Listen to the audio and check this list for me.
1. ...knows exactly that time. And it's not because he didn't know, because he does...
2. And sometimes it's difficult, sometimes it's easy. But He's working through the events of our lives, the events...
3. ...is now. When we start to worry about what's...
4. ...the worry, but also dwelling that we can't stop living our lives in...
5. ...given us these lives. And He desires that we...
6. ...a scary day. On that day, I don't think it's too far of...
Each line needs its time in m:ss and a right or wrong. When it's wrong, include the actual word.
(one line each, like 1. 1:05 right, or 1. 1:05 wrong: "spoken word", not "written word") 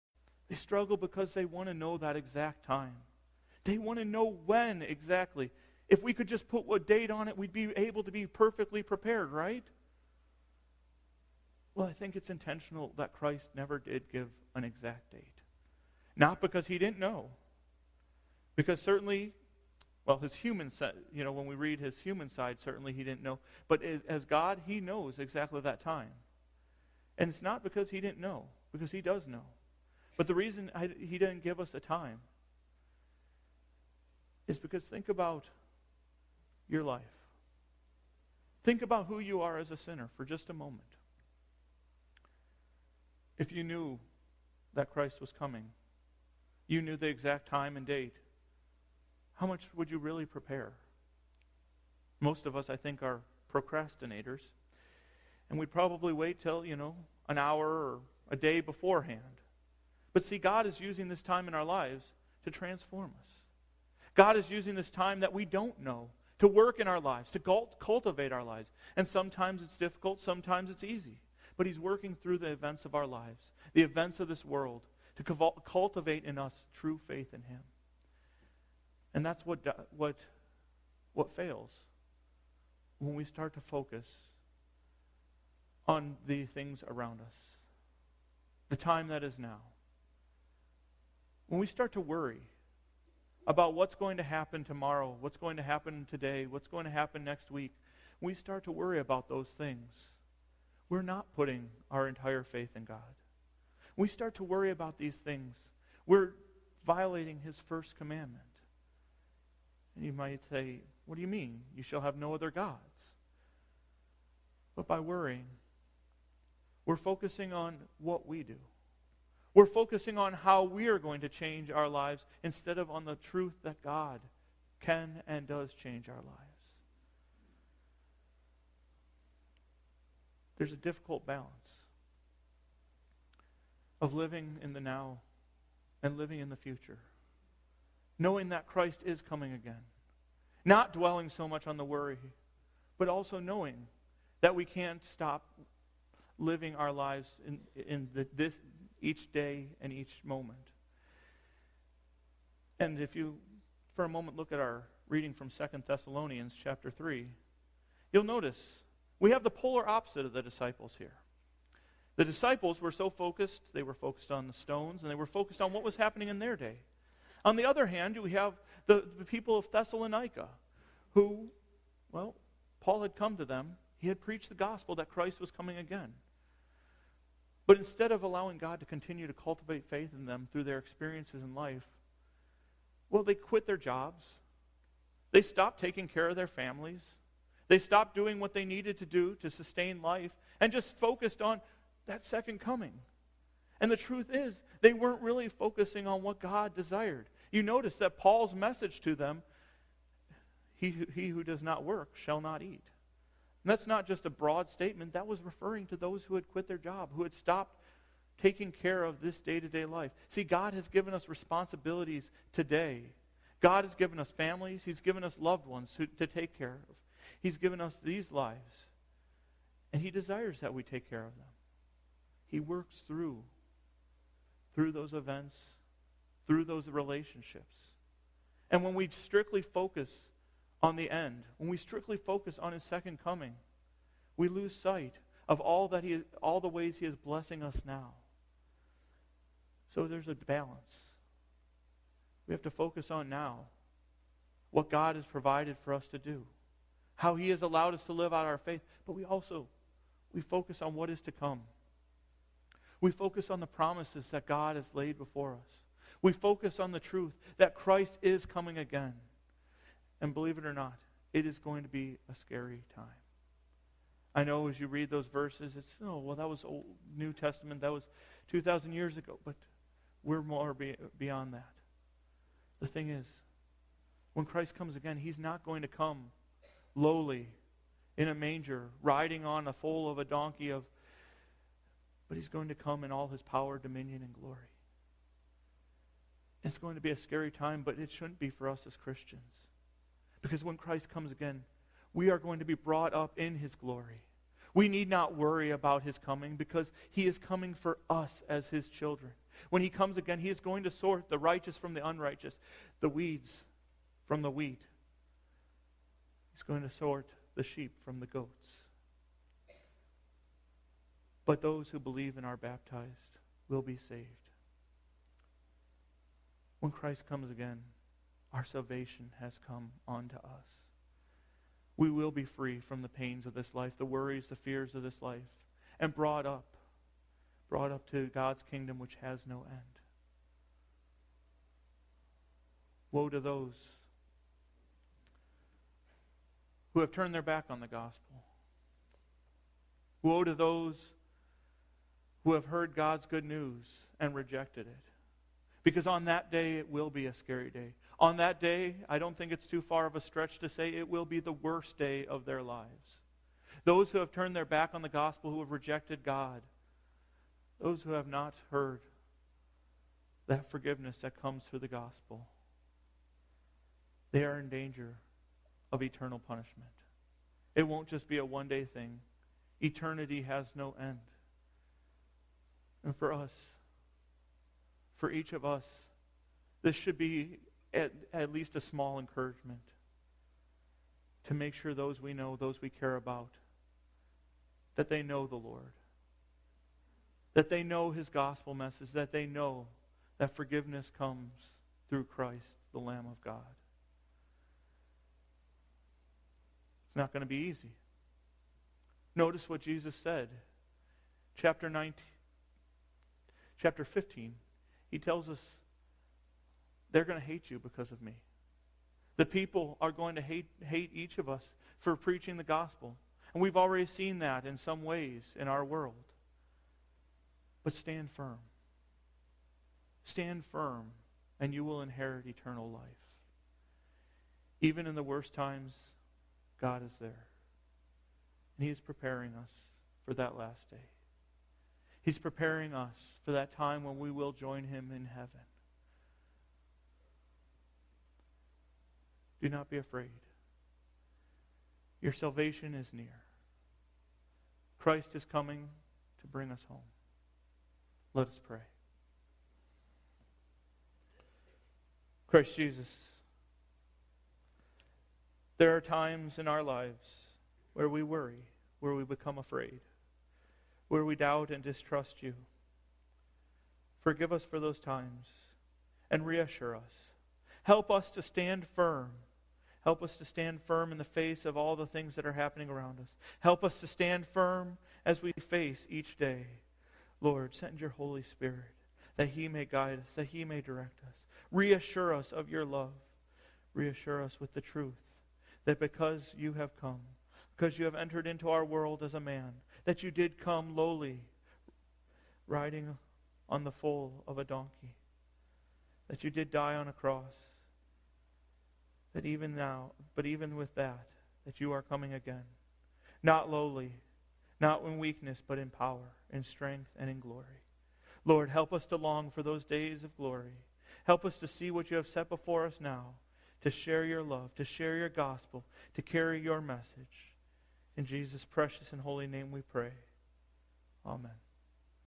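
1. 0:24 right
2. 1:08 right
3. 1:29 right
4. 2:21 wrong: "knowing", not "dwelling"
5. 3:37 right
6. 5:47 right.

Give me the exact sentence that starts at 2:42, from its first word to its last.
The disciples were so focused, they were focused on the stones, and they were focused on what was happening in their day.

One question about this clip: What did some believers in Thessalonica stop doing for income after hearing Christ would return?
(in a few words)
Quit their jobs.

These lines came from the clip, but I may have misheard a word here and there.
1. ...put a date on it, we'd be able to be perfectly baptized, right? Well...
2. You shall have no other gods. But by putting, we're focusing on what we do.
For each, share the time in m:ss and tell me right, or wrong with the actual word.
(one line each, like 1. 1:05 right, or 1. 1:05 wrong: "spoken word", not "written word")
1. 0:06 wrong: "prepared", not "baptized"
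2. 1:51 wrong: "worrying", not "putting".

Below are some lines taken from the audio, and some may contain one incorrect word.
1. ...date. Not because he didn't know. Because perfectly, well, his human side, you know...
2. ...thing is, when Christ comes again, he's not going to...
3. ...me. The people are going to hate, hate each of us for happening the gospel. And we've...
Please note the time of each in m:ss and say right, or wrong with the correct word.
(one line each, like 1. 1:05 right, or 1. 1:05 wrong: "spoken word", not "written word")
1. 0:15 wrong: "certainly", not "perfectly"
2. 4:32 right
3. 6:48 wrong: "preaching", not "happening".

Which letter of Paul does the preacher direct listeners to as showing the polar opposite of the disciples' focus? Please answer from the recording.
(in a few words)
Second Thessalonians chapter 3.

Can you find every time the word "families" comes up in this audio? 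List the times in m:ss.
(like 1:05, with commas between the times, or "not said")
3:06, 3:34.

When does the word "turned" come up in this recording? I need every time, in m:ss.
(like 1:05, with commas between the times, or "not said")
5:37, 5:54.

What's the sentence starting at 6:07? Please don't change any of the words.
It won't just be a one day thing, eternity has no end.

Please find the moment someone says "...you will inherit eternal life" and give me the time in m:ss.
7:01.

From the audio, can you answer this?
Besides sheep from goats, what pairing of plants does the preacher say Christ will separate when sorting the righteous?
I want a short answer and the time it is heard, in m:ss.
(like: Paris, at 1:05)
Weeds from the wheat, at 5:03.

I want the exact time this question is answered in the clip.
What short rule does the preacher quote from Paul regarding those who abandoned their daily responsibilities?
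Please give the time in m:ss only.
3:21.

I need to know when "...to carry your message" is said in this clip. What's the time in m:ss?
8:36.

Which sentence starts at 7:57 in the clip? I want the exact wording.
Lord, send your Holy Spirit that he may guide us, that he may direct us.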